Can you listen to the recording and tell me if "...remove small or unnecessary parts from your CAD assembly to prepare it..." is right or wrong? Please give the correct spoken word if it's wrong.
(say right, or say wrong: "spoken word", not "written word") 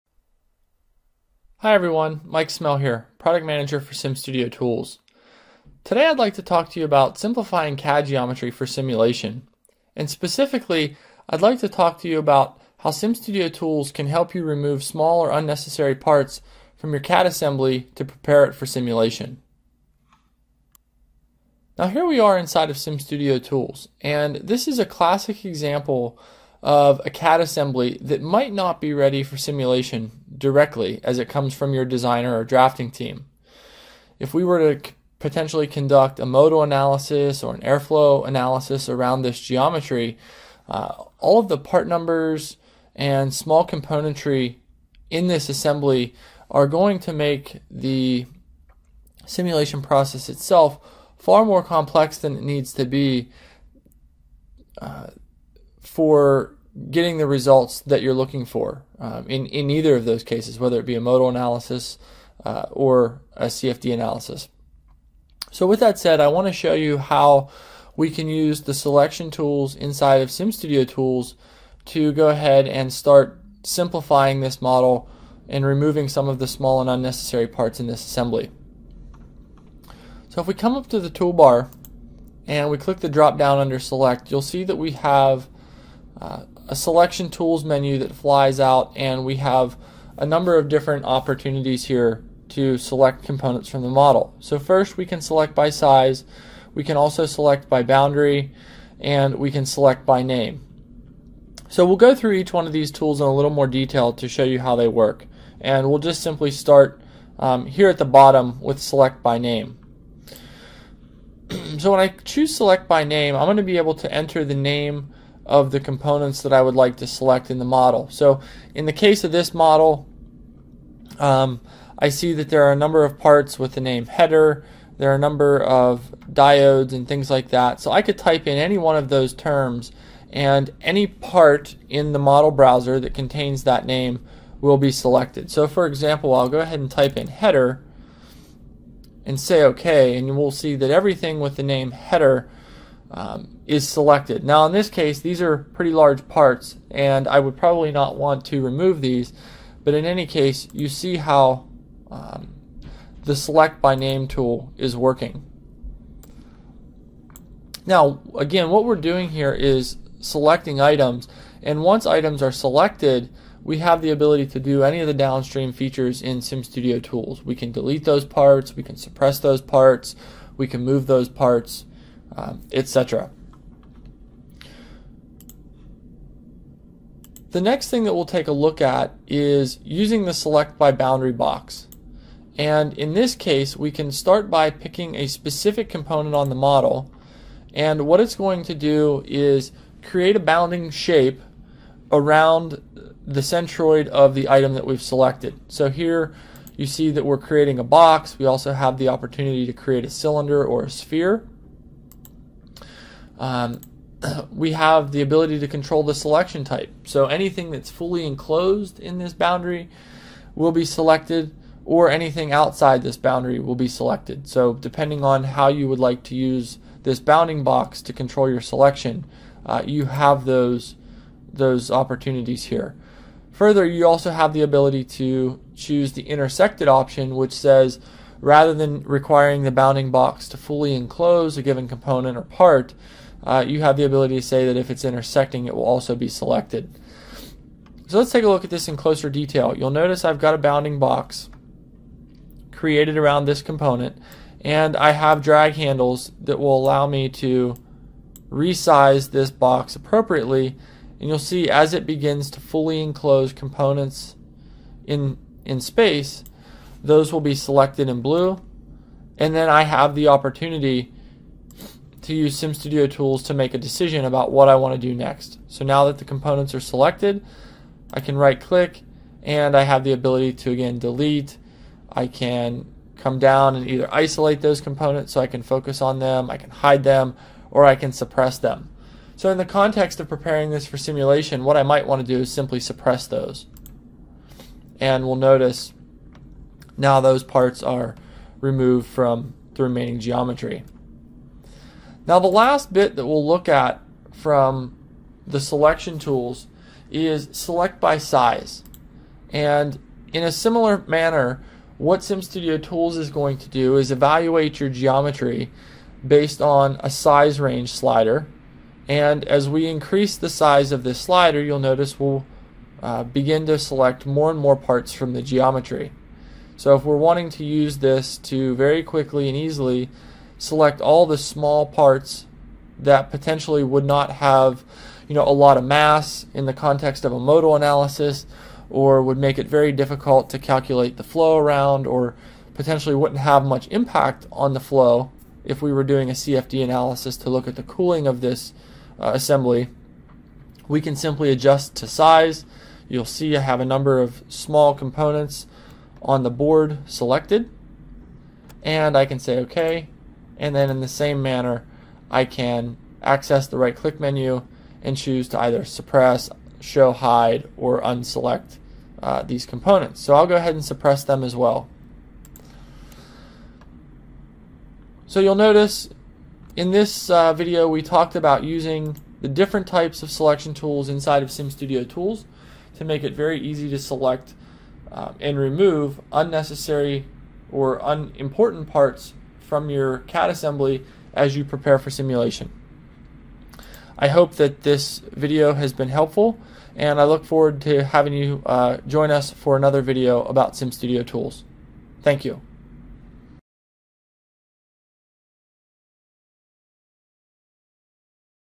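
right.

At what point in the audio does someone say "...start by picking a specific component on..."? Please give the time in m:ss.
3:04.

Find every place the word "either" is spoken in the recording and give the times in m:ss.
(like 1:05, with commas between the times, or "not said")
0:59, 4:33, 5:55.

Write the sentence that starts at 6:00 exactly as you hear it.
So I'll go ahead and suppress them as well.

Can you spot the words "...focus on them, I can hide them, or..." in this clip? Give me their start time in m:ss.
4:35.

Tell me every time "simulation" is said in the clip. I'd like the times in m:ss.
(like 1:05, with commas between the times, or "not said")
0:08, 0:18, 0:29, 0:49, 4:40, 6:22.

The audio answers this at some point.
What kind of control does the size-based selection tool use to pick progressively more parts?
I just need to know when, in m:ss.
5:07.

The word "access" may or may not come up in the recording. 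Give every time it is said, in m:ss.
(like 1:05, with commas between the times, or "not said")
5:53.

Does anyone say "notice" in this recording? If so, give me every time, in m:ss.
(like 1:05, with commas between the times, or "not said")
3:59, 4:45, 5:11, 6:05.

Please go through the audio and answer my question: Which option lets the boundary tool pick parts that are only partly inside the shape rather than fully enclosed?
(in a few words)
intersected.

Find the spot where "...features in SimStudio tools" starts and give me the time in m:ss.
2:45.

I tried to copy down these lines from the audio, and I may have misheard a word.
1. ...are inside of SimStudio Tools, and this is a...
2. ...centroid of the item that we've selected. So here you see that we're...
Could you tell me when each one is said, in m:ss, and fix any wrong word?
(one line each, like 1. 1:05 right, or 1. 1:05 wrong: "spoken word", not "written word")
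1. 0:22 right
2. 3:13 right.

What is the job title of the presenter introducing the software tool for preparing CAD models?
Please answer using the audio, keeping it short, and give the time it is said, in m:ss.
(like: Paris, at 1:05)
Product Manager, at 0:03.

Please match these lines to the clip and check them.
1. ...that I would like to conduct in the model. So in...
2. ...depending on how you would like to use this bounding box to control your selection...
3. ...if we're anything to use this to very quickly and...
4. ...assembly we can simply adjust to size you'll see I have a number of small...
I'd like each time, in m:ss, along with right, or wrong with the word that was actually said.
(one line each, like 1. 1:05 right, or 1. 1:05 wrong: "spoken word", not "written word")
1. 1:56 wrong: "select", not "conduct"
2. 3:34 right
3. 5:16 wrong: "wanting", not "anything"
4. 5:39 right.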